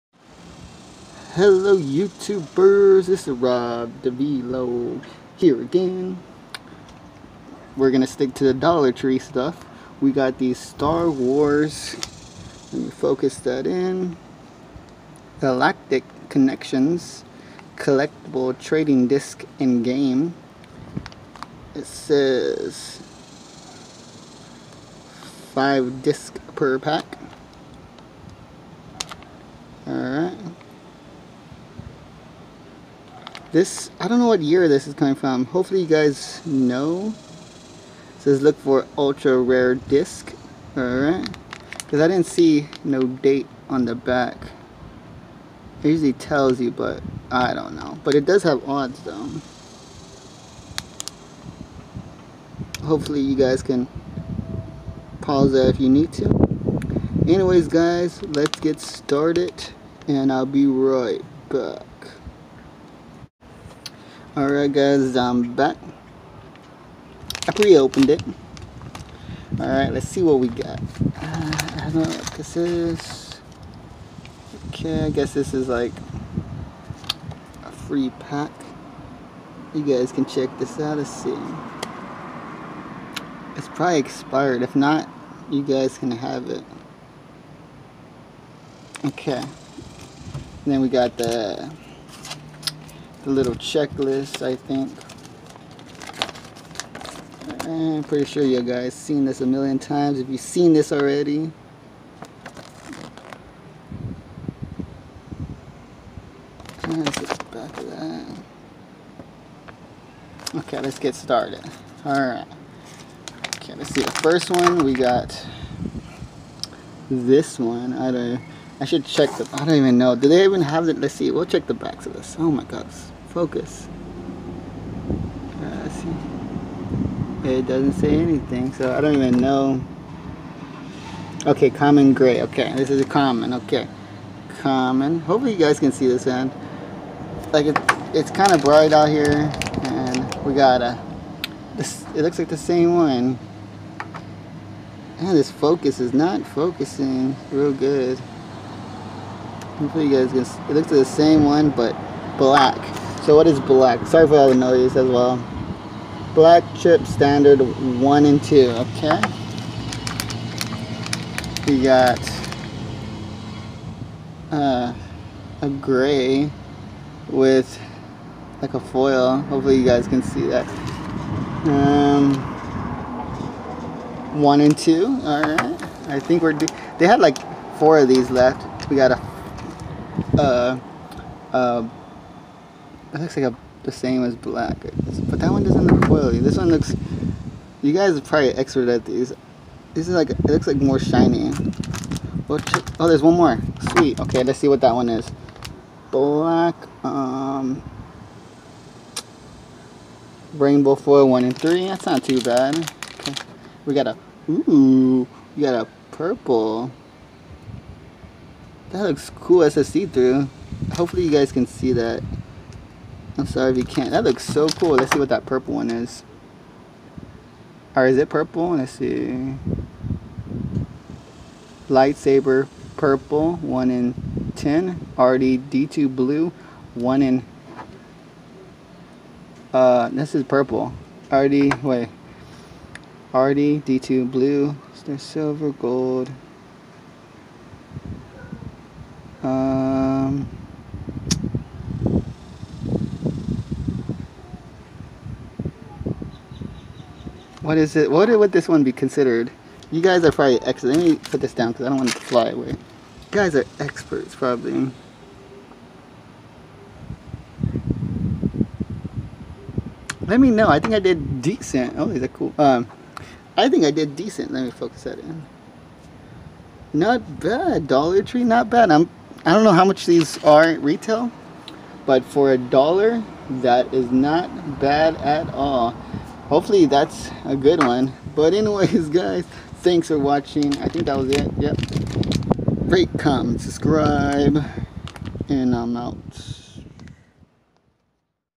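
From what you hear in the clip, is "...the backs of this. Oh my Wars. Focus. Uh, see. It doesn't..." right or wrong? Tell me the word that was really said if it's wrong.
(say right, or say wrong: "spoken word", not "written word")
wrong: "God", not "Wars".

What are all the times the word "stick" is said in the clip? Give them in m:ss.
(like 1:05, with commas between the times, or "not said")
0:08.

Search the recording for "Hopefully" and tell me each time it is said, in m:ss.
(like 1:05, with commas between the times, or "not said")
0:35, 0:52, 2:15, 2:29, 2:49, 3:30, 4:36.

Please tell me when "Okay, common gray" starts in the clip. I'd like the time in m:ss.
2:11.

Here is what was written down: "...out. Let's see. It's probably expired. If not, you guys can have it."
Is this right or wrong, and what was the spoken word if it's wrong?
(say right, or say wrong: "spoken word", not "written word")
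right.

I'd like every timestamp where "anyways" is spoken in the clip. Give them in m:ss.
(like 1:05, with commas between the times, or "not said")
0:57, 4:38.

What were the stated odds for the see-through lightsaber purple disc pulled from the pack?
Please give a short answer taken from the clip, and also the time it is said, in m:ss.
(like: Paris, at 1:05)
1 in 10, at 3:43.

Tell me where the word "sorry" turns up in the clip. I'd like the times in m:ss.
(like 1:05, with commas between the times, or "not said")
2:34, 3:33.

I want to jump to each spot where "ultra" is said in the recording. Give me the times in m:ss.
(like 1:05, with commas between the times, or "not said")
0:38.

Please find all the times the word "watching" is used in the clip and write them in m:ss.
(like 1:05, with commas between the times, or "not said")
4:40.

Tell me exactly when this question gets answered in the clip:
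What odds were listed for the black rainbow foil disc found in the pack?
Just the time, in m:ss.
3:21.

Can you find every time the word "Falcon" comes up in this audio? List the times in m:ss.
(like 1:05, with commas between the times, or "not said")
not said.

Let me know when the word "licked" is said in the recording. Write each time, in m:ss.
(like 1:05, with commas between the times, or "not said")
not said.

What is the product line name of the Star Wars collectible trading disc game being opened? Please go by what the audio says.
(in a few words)
Galactic Connexions.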